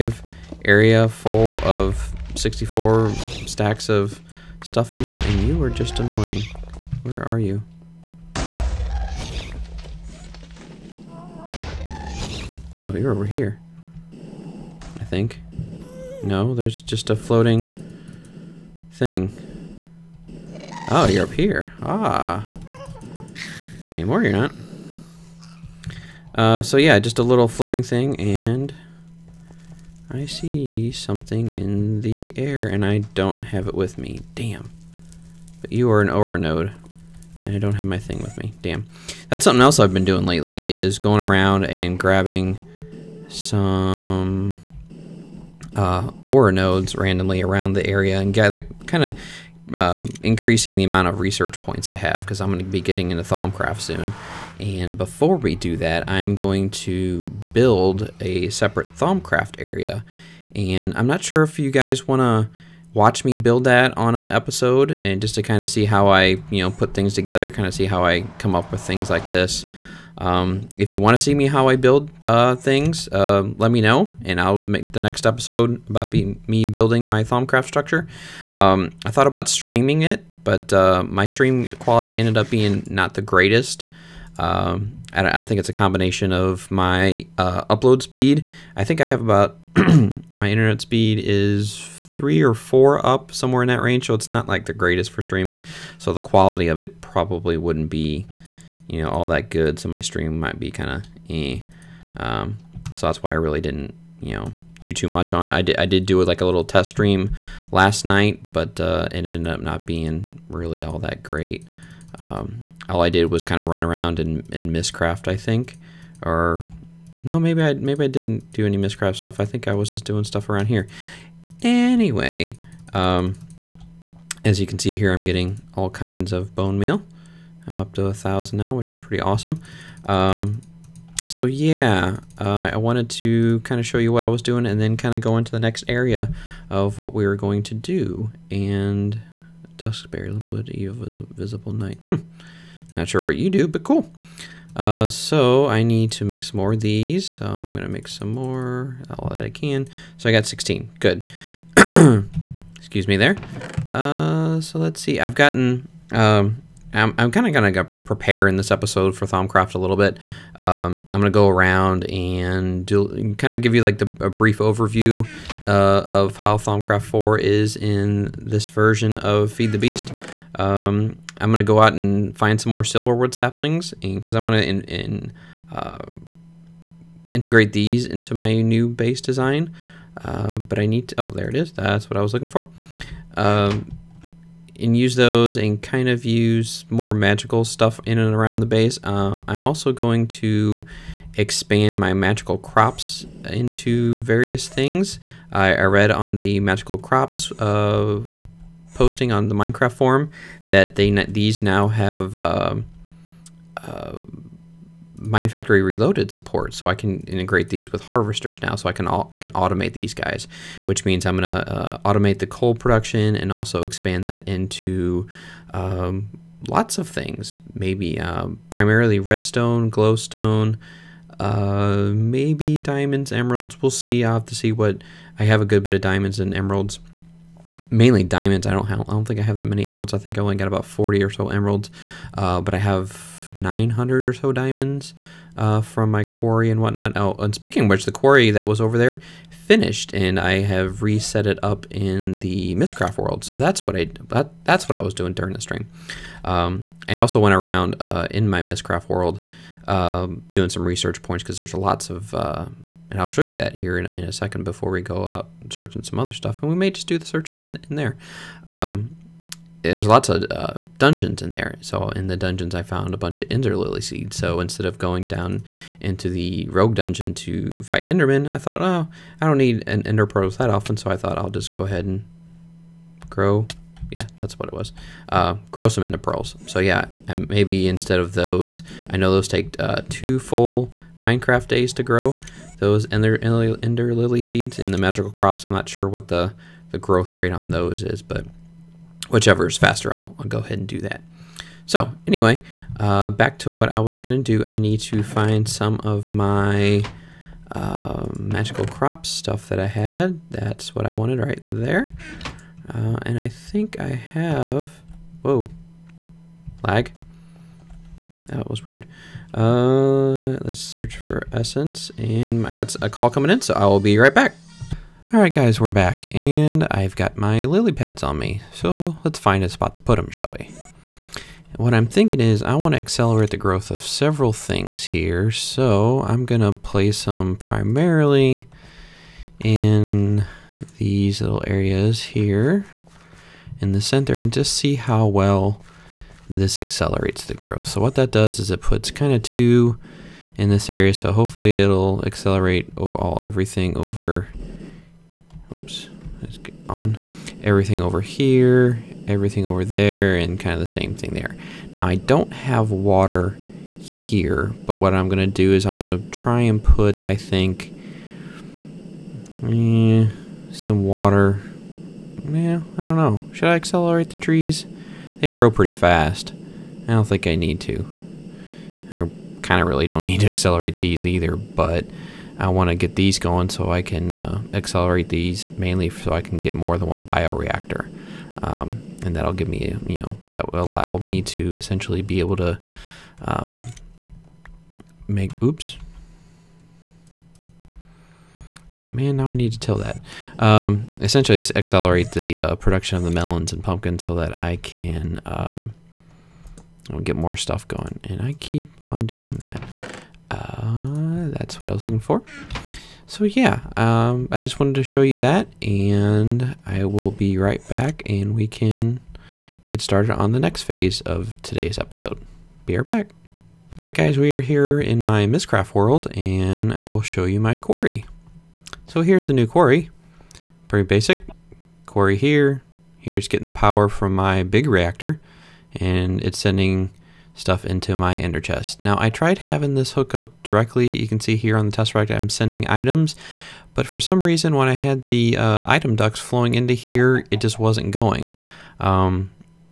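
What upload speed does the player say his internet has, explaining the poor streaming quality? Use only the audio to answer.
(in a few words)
3 or 4.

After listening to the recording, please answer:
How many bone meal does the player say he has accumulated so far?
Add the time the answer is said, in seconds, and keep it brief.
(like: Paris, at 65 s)
1000, at 128 s.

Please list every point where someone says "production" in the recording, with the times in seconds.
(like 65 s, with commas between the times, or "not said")
212 s, 392 s.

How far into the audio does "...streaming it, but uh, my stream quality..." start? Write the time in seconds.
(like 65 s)
79 s.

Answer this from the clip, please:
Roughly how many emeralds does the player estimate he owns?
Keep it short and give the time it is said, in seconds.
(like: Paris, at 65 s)
40, at 230 s.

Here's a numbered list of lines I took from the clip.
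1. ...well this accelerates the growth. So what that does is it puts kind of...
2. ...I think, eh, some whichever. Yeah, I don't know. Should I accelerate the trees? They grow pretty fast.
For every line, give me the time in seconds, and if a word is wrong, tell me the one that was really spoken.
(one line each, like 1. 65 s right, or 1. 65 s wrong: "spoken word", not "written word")
1. 335 s right
2. 357 s wrong: "water", not "whichever".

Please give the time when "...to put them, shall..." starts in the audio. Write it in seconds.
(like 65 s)
319 s.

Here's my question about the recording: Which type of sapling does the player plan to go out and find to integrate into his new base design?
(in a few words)
silverwood.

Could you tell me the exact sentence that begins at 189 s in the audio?
Uh, I'm also going to expand my magical crops into various things.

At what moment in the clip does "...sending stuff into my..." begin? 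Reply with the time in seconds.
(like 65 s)
426 s.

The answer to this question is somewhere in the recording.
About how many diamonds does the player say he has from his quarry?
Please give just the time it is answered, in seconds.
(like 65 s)
233 s.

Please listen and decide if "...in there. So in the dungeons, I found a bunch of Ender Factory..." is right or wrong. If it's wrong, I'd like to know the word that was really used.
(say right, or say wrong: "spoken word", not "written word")
wrong: "Lily", not "Factory".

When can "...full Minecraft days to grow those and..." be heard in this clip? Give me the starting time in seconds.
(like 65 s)
280 s.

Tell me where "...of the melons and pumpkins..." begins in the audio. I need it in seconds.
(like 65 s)
393 s.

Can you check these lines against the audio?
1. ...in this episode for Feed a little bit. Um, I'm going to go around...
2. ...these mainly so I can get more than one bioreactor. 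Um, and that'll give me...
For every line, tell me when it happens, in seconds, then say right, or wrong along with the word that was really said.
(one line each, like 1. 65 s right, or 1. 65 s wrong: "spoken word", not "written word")
1. 158 s wrong: "Thomcraft", not "Feed"
2. 375 s right.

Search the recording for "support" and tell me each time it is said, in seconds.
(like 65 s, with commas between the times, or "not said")
206 s.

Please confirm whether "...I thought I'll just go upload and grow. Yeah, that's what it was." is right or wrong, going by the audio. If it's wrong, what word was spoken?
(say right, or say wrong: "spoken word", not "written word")
wrong: "ahead", not "upload".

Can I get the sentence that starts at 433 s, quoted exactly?
But for some reason when I had the uh, item ducts flowing into here, it just wasn't going.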